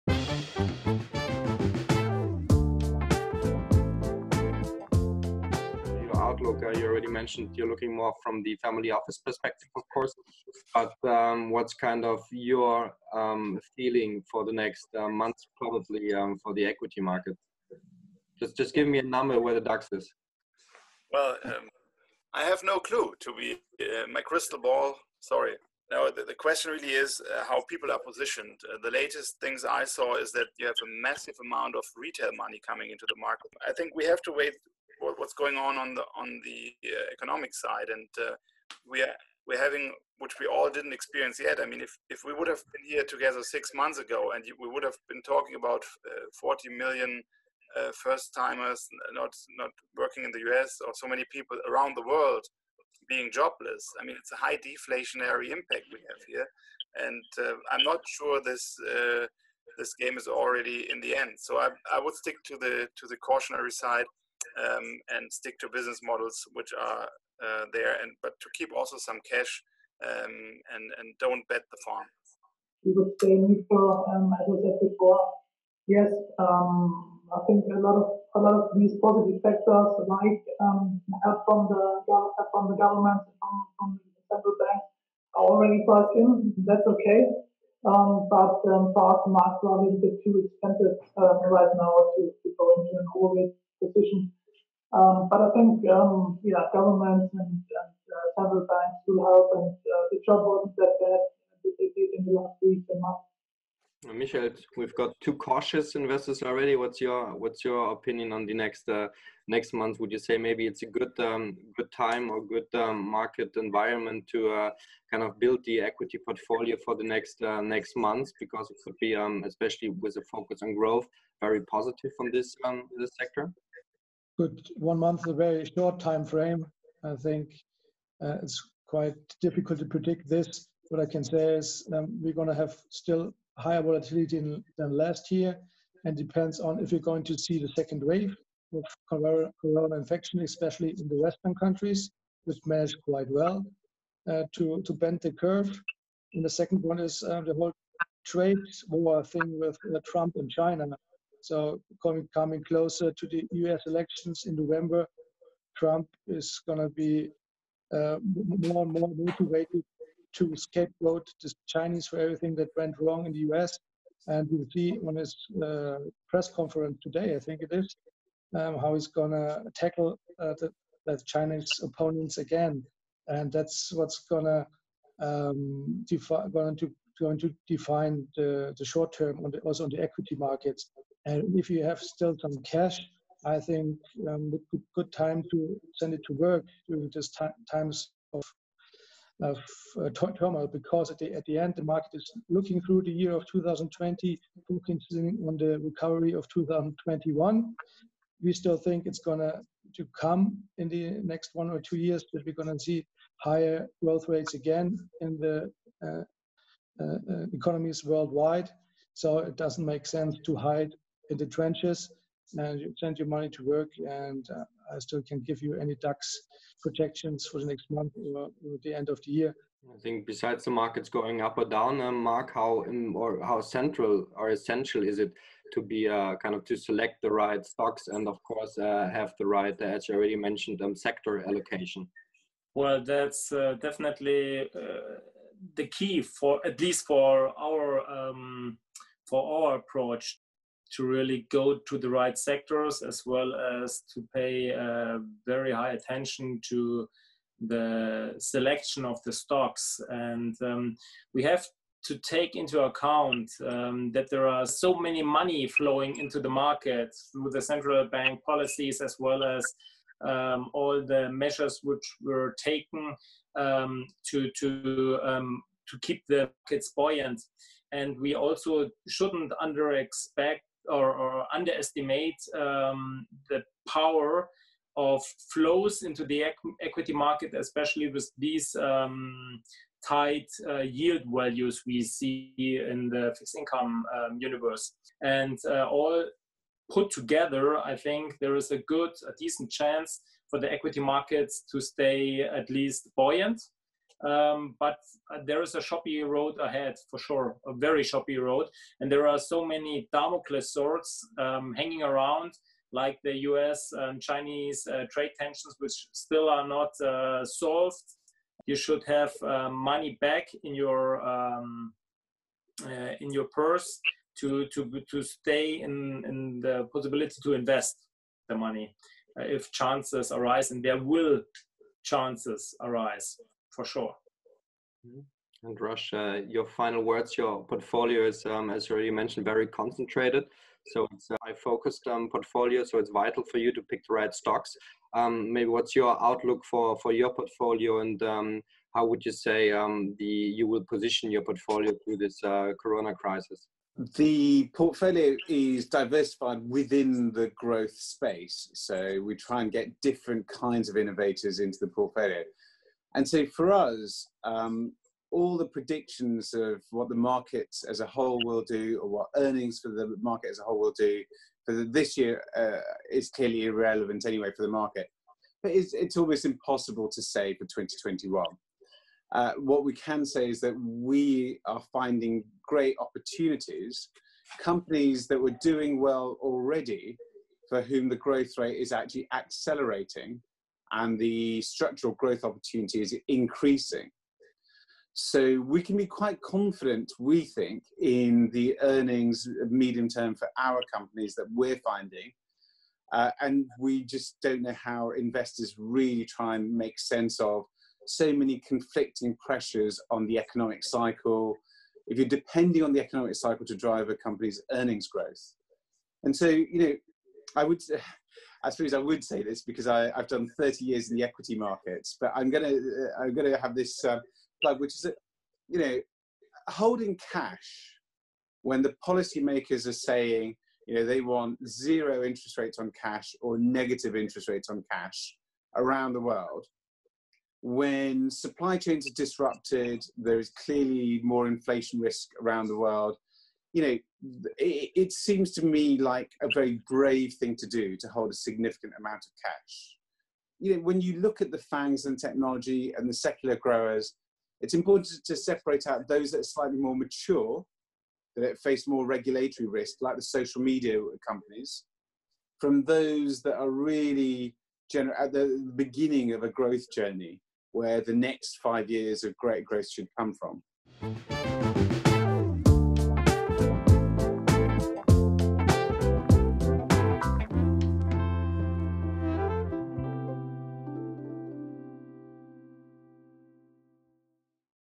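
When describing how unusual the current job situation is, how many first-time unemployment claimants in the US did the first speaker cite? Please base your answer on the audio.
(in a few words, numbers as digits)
40 million.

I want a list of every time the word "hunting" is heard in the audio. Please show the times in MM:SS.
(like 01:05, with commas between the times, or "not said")
not said.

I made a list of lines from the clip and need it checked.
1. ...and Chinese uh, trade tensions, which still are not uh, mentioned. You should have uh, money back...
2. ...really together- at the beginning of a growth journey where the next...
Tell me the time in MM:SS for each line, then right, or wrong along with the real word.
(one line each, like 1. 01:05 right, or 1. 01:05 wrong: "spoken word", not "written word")
1. 05:03 wrong: "solved", not "mentioned"
2. 07:33 wrong: "gener", not "together".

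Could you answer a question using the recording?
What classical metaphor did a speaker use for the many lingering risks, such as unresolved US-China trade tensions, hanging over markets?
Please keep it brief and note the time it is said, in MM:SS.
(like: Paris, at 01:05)
Damocles swords, at 05:00.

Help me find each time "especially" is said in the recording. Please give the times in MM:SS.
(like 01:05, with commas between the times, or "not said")
01:59, 02:20, 04:37.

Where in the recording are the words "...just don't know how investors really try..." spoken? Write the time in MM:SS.
06:34.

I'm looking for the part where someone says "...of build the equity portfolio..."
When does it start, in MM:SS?
01:55.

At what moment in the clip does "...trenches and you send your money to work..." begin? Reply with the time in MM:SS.
03:31.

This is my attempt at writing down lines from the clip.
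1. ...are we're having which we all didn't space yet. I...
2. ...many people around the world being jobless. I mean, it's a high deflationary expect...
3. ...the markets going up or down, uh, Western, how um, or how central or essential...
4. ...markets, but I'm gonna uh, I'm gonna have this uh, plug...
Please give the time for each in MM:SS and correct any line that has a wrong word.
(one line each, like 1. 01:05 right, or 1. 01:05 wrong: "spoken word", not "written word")
1. 00:39 wrong: "experience", not "space"
2. 00:51 wrong: "impact", not "expect"
3. 03:40 wrong: "Marc", not "Western"
4. 06:51 right.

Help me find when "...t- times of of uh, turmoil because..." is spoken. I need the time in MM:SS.
03:07.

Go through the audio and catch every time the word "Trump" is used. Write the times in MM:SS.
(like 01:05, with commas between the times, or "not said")
02:30, 02:35.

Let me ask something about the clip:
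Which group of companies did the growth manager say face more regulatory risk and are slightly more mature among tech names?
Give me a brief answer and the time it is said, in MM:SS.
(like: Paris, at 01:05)
social media companies, at 07:30.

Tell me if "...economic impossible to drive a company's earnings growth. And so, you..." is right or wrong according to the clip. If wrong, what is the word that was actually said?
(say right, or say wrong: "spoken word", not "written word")
wrong: "cycle", not "impossible".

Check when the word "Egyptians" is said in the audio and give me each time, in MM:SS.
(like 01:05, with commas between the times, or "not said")
not said.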